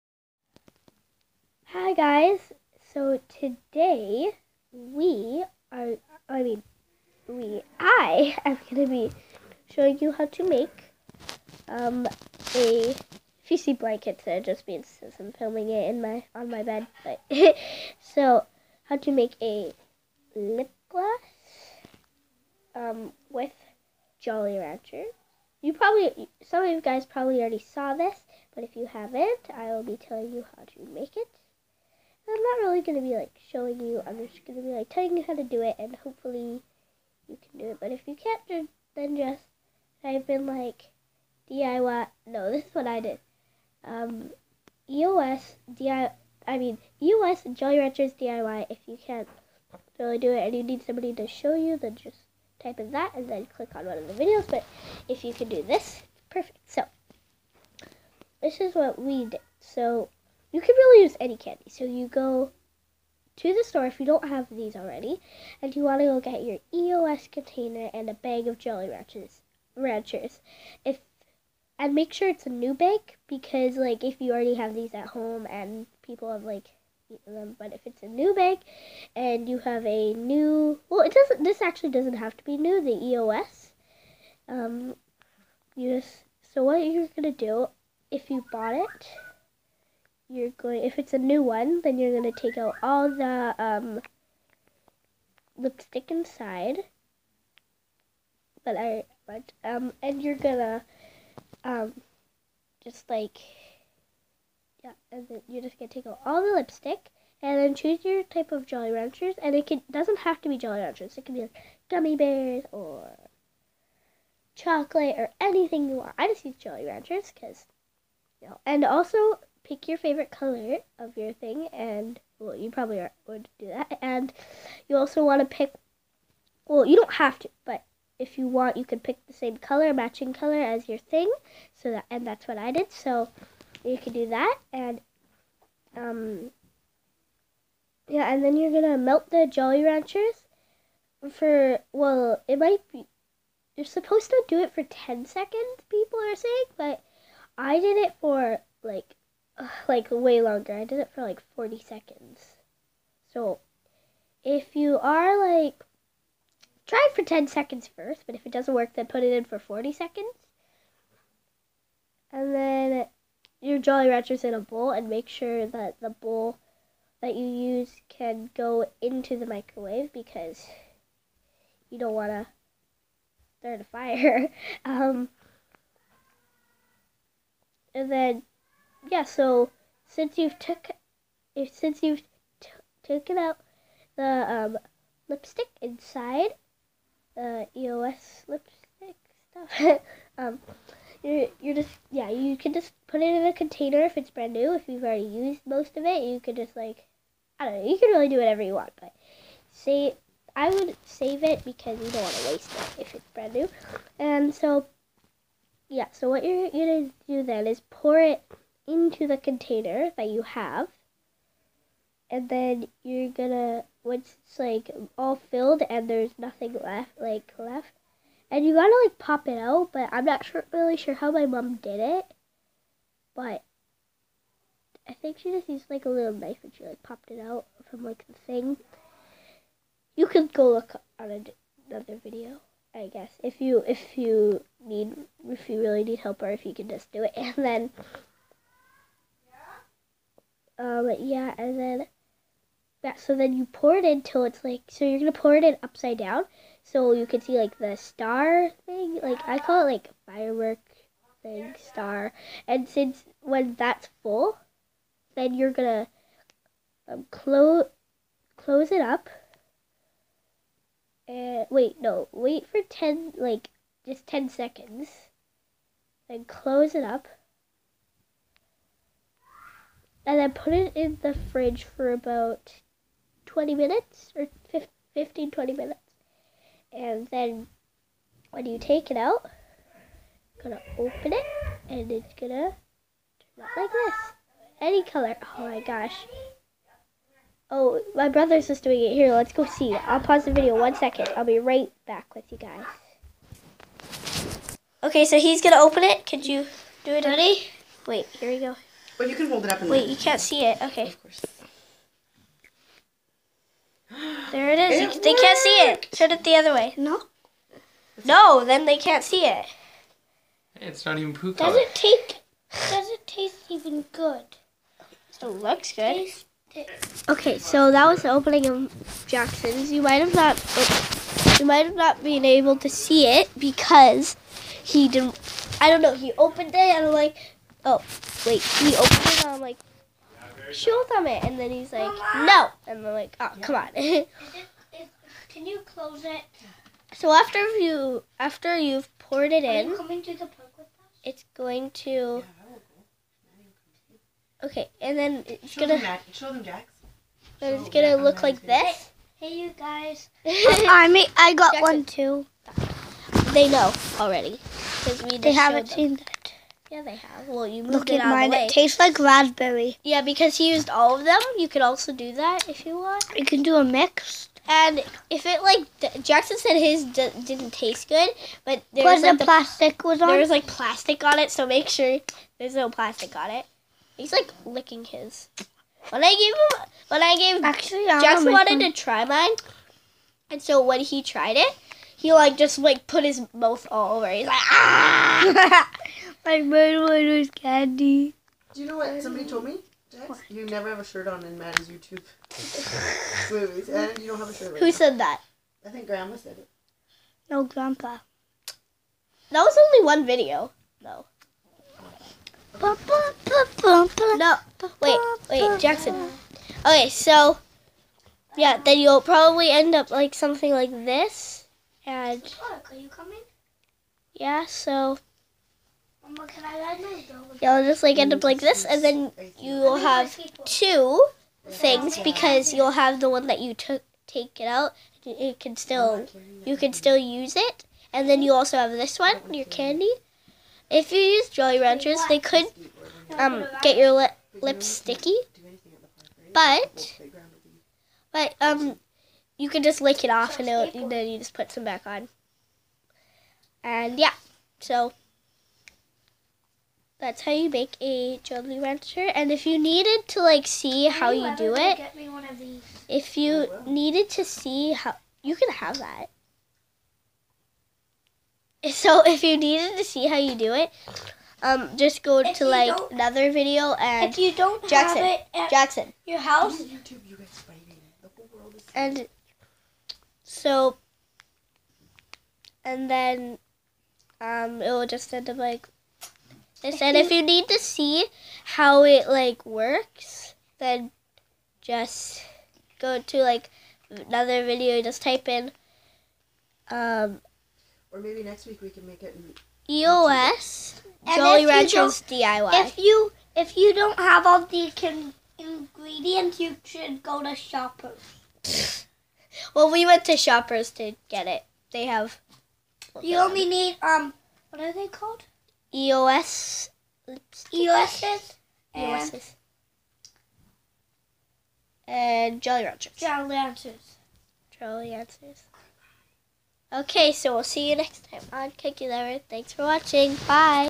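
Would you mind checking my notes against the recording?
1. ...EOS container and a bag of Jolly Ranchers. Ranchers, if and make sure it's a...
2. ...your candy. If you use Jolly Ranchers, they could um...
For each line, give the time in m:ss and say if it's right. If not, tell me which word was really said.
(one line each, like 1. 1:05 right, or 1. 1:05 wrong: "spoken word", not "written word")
1. 1:06 right
2. 7:09 right.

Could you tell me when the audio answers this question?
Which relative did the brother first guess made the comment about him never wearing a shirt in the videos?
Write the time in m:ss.
6:36.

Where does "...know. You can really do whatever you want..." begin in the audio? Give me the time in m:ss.
3:17.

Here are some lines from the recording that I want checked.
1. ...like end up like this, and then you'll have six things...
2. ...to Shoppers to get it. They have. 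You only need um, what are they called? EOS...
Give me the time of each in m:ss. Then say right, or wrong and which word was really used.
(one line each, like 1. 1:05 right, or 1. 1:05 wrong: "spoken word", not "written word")
1. 6:58 wrong: "two", not "six"
2. 8:20 right.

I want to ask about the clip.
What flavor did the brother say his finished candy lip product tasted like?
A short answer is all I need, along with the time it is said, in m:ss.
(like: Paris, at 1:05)
Raspberry, at 5:59.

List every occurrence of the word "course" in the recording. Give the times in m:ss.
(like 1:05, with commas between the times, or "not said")
5:01.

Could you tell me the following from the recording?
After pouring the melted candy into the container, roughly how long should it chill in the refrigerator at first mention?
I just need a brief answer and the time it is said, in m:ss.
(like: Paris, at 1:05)
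20 minutes, at 4:32.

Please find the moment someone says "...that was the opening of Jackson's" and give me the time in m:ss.
5:17.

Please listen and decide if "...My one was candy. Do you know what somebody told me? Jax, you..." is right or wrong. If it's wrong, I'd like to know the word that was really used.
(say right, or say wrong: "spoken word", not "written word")
right.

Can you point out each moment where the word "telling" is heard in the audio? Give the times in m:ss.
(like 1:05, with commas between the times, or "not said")
0:29, 0:34.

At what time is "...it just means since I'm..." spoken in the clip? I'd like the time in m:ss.
0:14.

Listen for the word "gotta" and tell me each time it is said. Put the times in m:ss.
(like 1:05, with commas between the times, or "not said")
3:38.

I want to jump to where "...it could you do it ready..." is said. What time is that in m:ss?
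4:56.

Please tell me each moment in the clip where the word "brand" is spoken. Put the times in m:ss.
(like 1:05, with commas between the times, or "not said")
3:14, 3:23.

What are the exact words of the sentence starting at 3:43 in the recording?
But I think she just used like a little knife and she like popped it out from like the thing.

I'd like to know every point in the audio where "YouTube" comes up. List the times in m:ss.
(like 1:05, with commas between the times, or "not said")
6:31, 7:46.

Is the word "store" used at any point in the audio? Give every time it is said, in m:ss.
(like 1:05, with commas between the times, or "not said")
1:03.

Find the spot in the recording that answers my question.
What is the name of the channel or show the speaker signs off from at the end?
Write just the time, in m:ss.
8:38.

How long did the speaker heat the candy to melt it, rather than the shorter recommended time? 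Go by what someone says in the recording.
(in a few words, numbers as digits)
40 seconds.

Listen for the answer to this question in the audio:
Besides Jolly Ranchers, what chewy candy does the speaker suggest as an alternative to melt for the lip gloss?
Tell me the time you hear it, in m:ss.
1:51.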